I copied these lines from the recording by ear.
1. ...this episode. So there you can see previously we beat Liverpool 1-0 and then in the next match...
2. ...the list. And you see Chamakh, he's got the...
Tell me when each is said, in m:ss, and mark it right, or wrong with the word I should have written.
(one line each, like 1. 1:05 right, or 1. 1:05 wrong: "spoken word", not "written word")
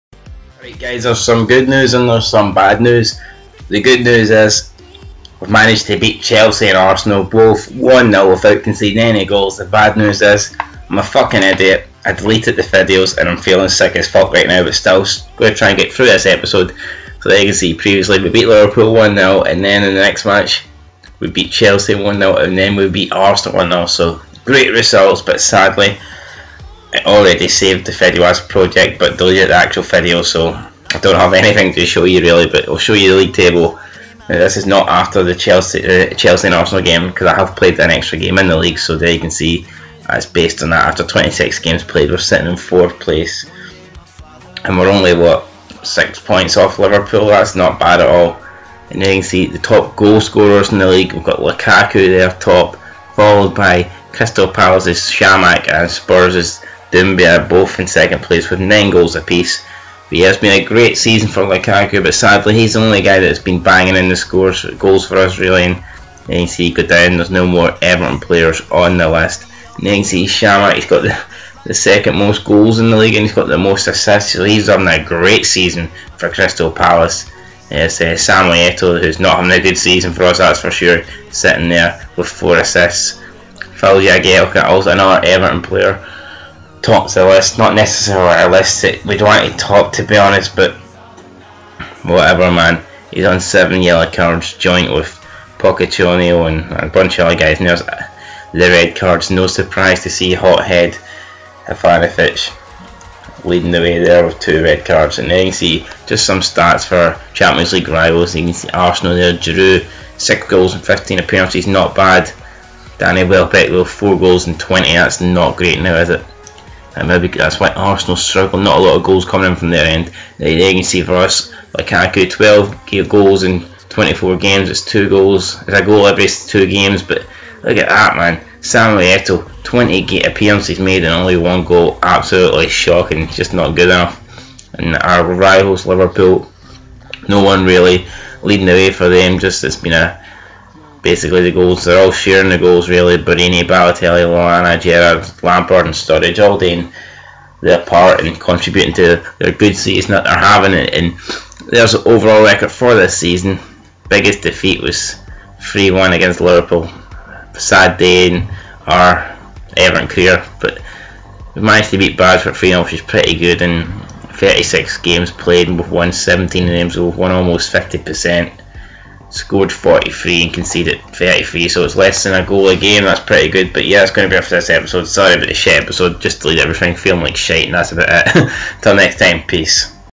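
1. 0:16 right
2. 1:08 right.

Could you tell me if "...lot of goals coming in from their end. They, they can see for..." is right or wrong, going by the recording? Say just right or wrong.
right.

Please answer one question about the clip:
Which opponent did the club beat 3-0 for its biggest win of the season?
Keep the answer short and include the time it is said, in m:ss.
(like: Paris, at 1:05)
Bradford, at 2:42.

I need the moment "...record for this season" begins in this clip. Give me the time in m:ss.
2:32.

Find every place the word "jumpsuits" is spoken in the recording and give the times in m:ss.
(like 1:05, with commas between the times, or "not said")
not said.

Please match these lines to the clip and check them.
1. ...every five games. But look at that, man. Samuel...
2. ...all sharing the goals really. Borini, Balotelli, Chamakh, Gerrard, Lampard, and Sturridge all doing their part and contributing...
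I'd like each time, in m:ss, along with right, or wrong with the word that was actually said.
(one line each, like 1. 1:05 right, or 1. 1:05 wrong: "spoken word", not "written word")
1. 2:06 wrong: "two", not "five"
2. 2:22 wrong: "Lallana", not "Chamakh".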